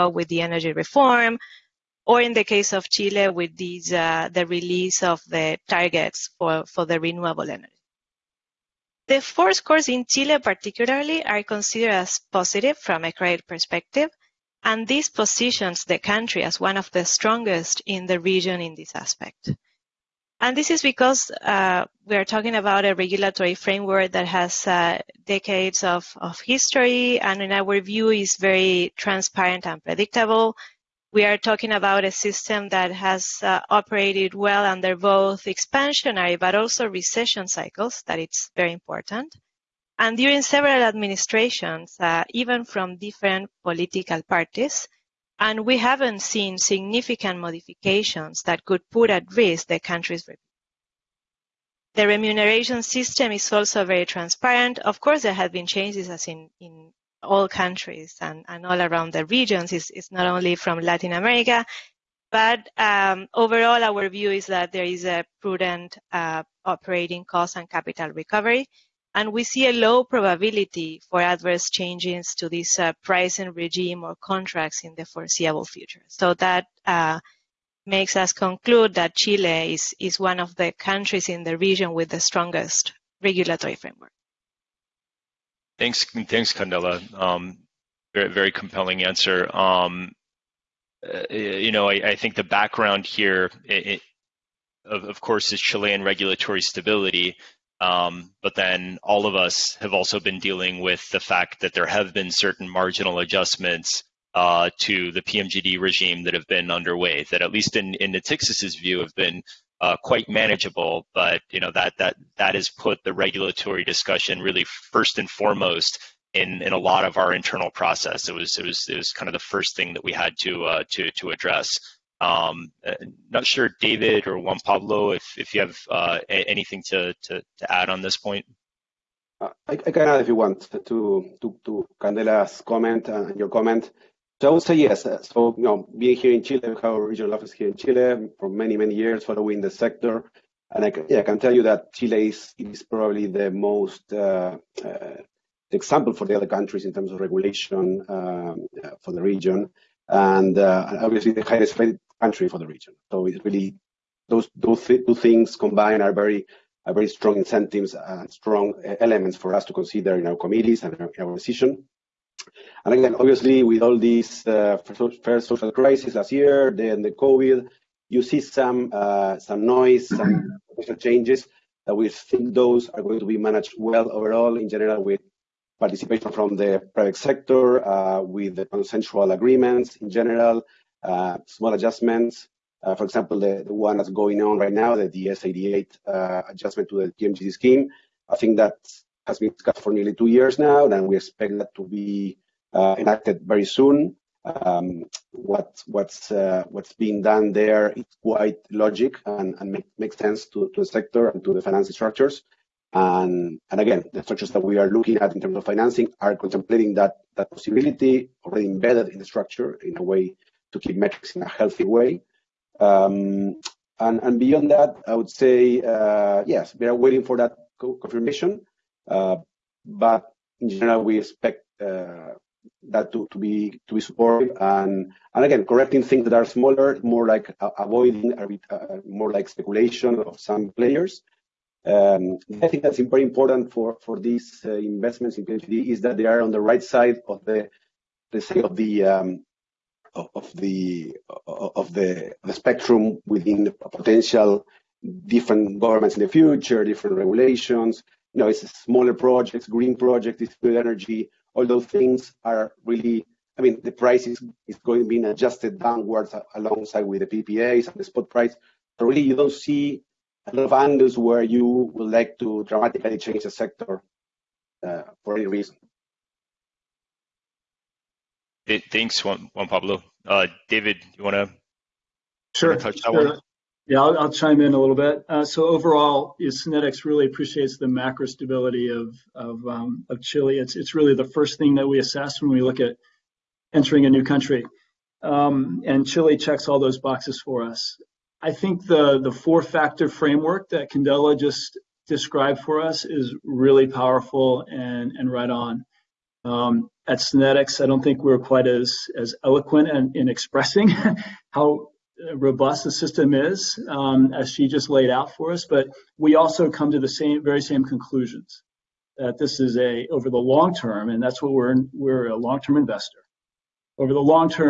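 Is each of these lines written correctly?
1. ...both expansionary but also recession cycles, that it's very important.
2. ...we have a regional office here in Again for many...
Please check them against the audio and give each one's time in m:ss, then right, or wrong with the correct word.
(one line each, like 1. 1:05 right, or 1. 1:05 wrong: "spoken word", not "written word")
1. 0:34 right
2. 2:16 wrong: "Chile", not "Again".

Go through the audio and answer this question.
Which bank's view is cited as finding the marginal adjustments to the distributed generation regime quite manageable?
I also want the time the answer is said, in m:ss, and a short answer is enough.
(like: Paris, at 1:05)
Natixis, at 1:48.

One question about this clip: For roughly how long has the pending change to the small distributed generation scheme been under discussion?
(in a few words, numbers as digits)
nearly two years.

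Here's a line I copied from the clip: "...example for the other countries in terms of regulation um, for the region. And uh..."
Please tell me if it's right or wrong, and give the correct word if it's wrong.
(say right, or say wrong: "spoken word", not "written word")
right.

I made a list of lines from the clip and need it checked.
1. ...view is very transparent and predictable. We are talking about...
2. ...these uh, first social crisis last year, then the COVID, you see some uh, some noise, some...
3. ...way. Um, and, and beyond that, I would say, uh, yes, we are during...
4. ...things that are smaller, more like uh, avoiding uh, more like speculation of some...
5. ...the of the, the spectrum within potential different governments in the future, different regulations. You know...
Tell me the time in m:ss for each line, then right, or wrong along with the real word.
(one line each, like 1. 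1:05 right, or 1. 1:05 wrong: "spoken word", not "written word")
1. 0:27 right
2. 2:43 right
3. 3:31 wrong: "waiting", not "during"
4. 3:46 right
5. 4:00 right.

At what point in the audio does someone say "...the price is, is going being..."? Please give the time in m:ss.
4:13.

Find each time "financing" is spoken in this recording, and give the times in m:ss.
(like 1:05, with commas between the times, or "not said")
3:21, 3:25.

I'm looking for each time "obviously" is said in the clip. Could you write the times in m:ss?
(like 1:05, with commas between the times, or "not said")
2:31, 2:43.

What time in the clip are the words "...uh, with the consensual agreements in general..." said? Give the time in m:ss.
2:57.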